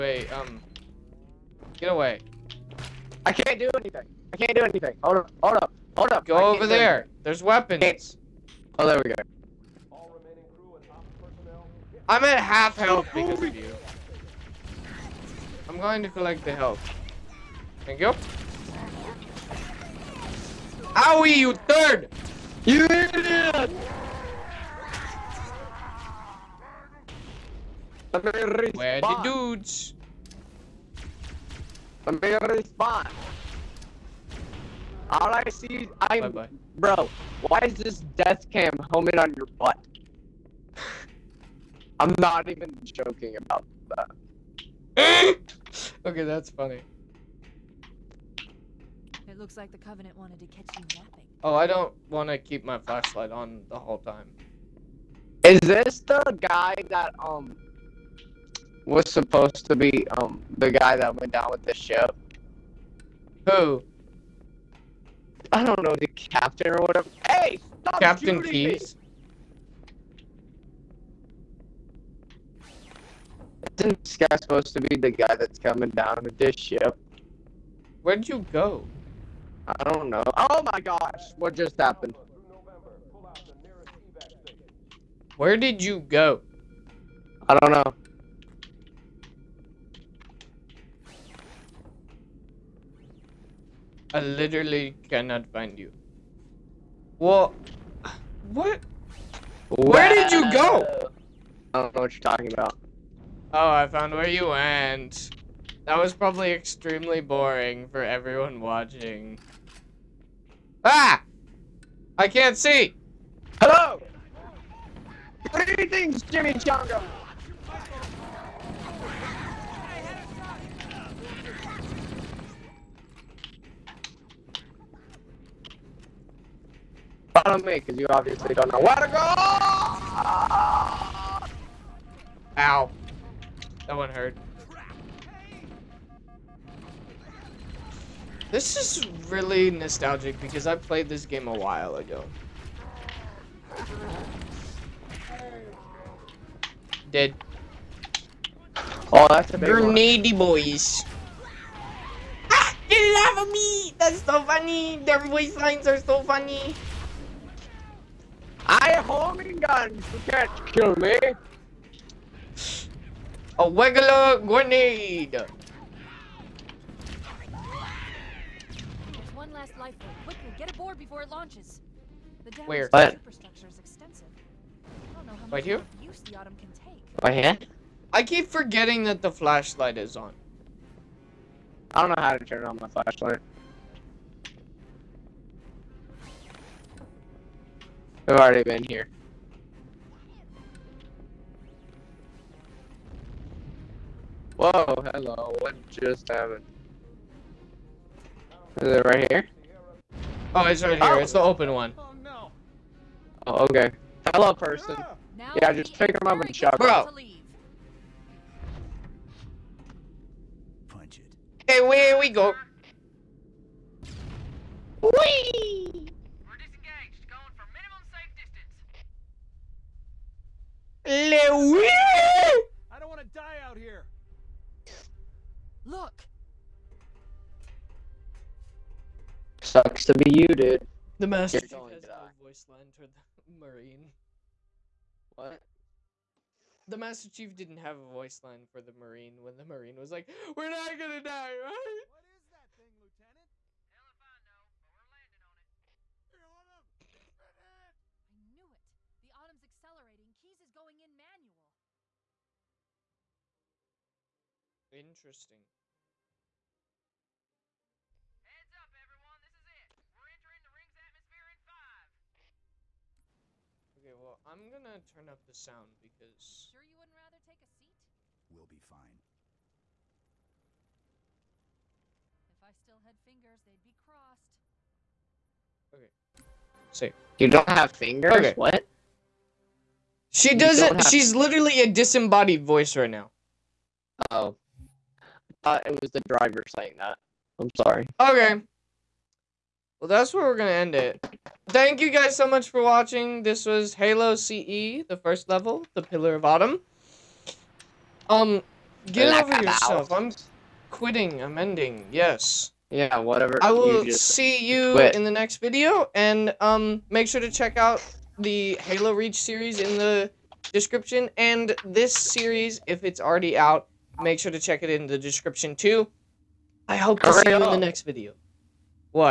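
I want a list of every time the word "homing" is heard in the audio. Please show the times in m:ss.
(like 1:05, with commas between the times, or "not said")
0:38, 2:39.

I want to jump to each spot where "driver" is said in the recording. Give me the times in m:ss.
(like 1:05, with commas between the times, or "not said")
4:46.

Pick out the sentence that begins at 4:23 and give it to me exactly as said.
Okay, well, I'm gonna turn up the sound because...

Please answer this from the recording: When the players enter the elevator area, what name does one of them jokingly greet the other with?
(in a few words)
Jimmy Chongo.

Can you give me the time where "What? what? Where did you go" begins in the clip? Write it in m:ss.
1:37.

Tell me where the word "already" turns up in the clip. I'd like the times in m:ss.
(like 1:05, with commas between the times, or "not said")
3:08, 5:13.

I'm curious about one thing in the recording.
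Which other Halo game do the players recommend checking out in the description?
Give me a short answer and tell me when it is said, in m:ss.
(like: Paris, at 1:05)
Halo Reach, at 5:08.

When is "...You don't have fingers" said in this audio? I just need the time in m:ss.
4:37.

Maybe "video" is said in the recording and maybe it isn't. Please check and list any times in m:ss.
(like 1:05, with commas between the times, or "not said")
5:05, 5:18.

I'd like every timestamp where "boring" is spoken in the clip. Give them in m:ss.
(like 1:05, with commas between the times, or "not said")
1:47.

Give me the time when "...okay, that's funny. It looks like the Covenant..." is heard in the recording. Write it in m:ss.
0:46.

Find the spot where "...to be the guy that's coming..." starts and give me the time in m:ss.
1:14.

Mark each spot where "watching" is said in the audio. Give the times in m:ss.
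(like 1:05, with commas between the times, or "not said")
1:48, 4:52.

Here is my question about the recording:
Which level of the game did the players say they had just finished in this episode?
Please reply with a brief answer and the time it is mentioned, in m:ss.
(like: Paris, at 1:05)
The Pillar of Autumn, at 4:55.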